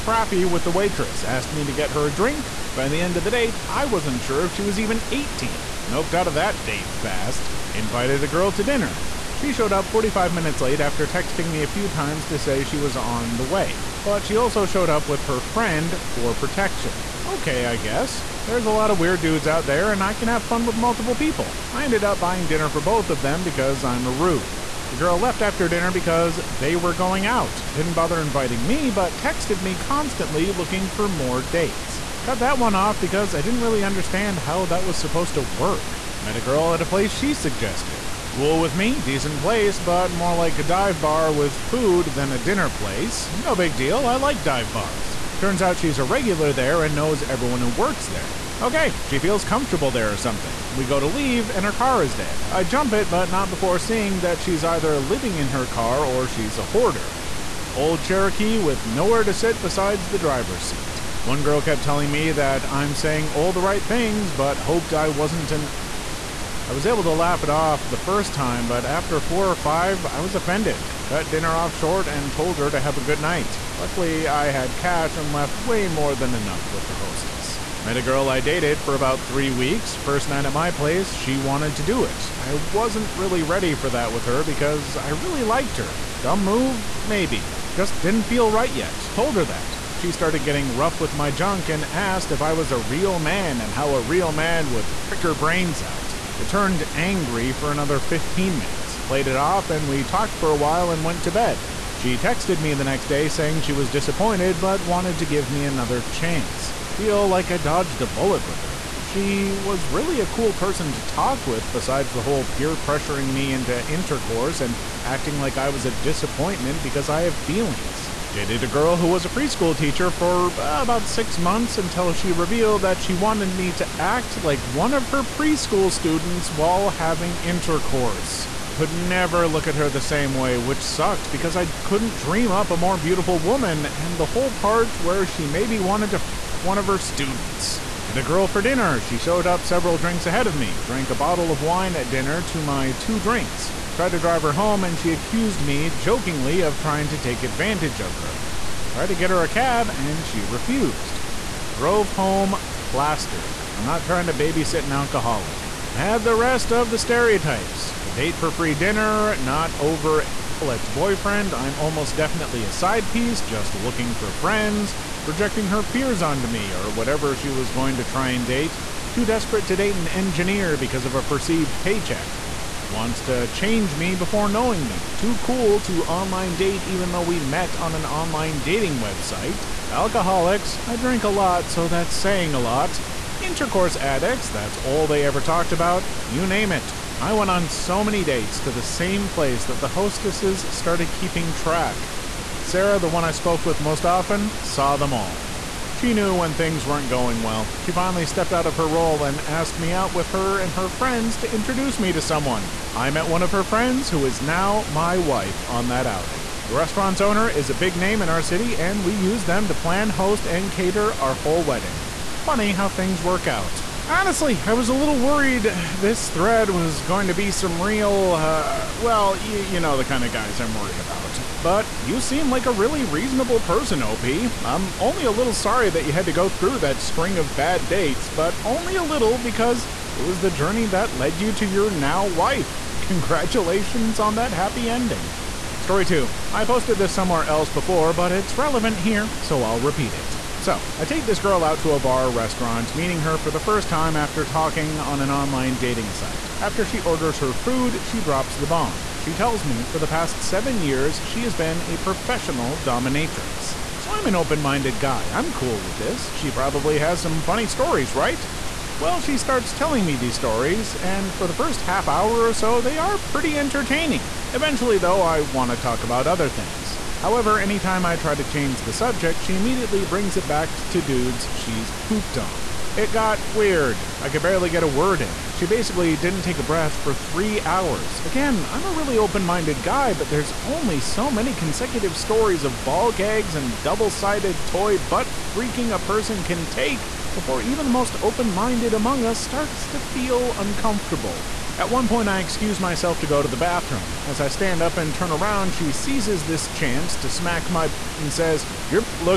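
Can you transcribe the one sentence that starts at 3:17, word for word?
She finally stepped out of her role and asked me out with her and her friends to introduce me to someone.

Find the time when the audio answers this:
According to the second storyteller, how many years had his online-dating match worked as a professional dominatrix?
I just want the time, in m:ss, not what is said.
4:10.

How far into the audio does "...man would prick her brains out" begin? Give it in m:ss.
1:34.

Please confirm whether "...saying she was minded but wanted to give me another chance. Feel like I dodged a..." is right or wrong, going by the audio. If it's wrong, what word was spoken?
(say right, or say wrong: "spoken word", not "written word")
wrong: "disappointed", not "minded".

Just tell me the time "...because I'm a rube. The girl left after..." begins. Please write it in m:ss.
0:23.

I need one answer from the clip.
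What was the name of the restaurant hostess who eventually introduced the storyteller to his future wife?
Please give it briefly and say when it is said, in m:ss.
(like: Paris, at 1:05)
Sarah, at 3:12.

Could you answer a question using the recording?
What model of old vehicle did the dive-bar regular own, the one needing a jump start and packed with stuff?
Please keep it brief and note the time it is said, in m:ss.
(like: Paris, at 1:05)
Cherokee, at 0:58.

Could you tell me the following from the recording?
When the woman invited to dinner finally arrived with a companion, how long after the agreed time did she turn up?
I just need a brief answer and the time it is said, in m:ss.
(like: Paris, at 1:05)
45 minutes, at 0:09.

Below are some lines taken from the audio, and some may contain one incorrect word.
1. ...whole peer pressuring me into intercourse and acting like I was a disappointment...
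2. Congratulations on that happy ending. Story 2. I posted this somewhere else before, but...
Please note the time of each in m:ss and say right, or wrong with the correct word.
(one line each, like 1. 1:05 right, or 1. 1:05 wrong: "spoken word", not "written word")
1. 1:52 right
2. 3:53 right.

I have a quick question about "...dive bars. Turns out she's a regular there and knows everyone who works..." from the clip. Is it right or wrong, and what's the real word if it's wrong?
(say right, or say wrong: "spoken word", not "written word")
right.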